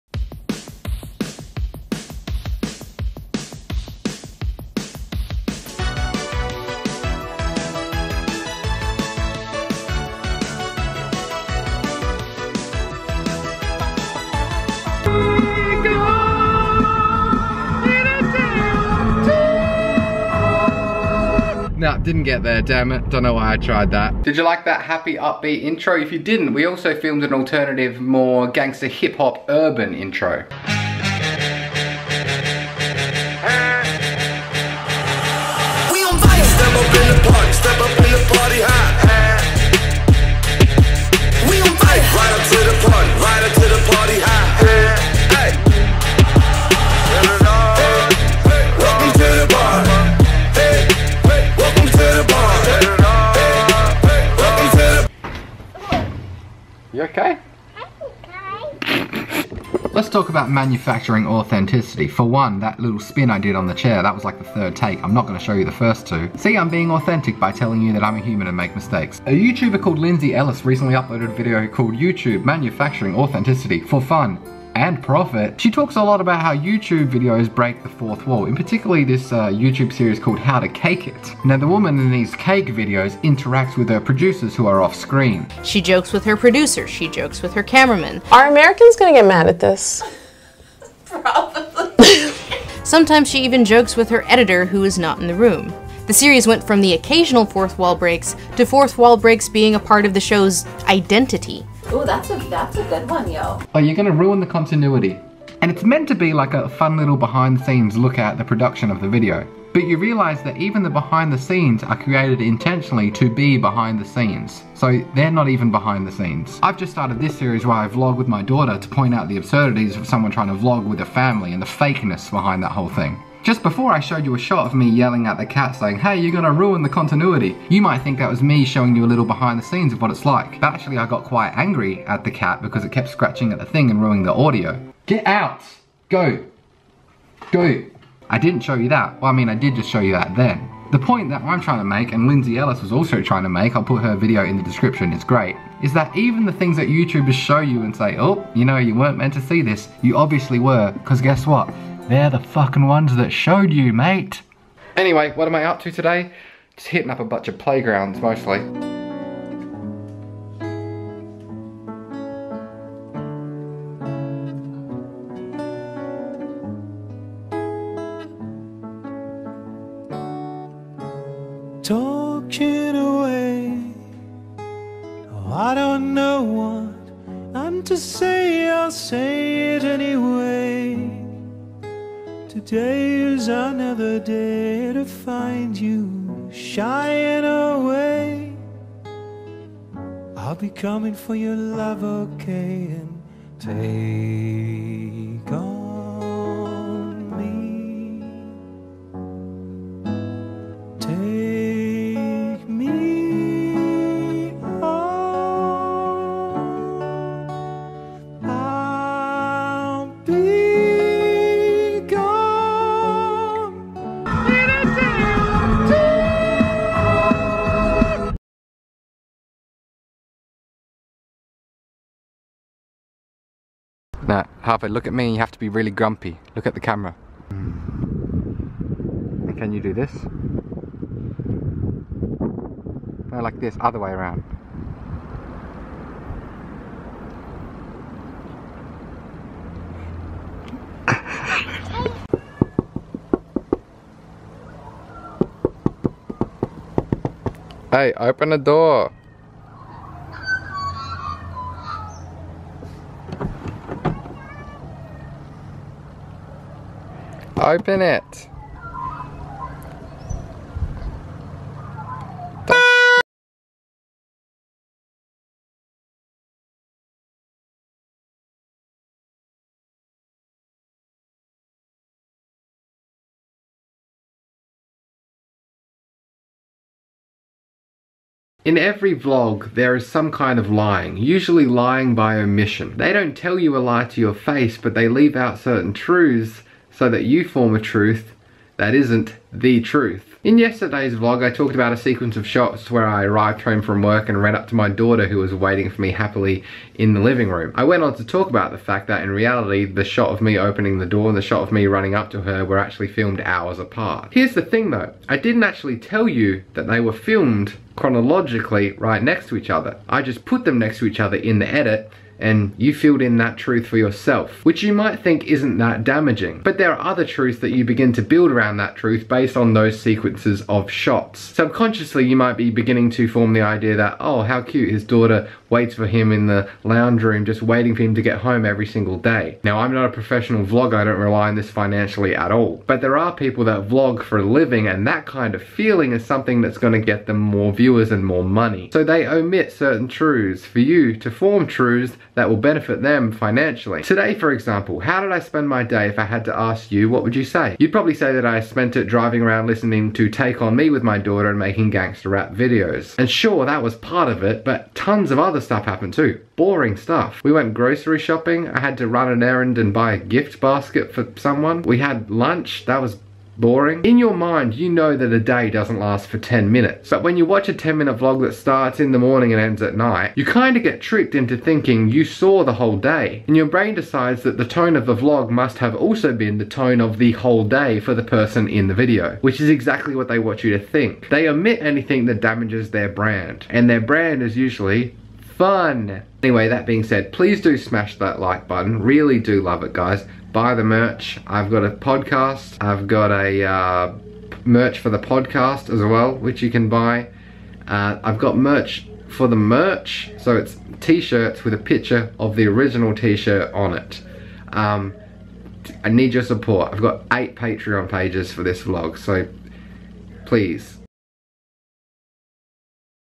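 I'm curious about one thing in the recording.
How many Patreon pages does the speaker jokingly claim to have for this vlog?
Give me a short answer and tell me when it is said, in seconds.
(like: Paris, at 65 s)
8, at 407 s.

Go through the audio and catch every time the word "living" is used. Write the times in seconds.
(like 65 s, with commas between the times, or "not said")
297 s, 334 s.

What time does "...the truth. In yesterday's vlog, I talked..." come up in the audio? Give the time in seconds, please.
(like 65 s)
289 s.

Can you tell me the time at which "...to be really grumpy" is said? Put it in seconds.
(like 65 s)
225 s.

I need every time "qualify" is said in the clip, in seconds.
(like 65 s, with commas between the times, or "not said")
not said.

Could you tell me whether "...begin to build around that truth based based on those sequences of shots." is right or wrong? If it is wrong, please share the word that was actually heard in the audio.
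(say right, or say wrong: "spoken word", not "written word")
right.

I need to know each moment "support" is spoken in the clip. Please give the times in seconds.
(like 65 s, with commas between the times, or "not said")
406 s.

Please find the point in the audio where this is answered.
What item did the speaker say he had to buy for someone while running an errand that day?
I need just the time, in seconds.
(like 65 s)
360 s.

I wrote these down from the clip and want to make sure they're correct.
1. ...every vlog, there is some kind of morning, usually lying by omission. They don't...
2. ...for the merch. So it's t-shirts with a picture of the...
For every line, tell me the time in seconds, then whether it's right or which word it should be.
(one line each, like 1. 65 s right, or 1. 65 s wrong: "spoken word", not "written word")
1. 278 s wrong: "lying", not "morning"
2. 399 s right.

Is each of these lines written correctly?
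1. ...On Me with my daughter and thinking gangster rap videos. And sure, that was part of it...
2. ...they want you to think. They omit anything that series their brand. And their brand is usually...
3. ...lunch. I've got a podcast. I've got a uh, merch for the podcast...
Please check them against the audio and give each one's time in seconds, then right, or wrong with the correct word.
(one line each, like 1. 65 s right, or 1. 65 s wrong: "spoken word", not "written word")
1. 350 s wrong: "making", not "thinking"
2. 380 s wrong: "damages", not "series"
3. 390 s wrong: "merch", not "lunch".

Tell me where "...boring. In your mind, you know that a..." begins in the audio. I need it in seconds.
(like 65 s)
363 s.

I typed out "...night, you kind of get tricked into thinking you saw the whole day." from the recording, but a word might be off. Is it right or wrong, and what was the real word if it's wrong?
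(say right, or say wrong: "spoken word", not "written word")
right.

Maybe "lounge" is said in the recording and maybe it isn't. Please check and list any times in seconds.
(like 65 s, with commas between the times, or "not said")
326 s.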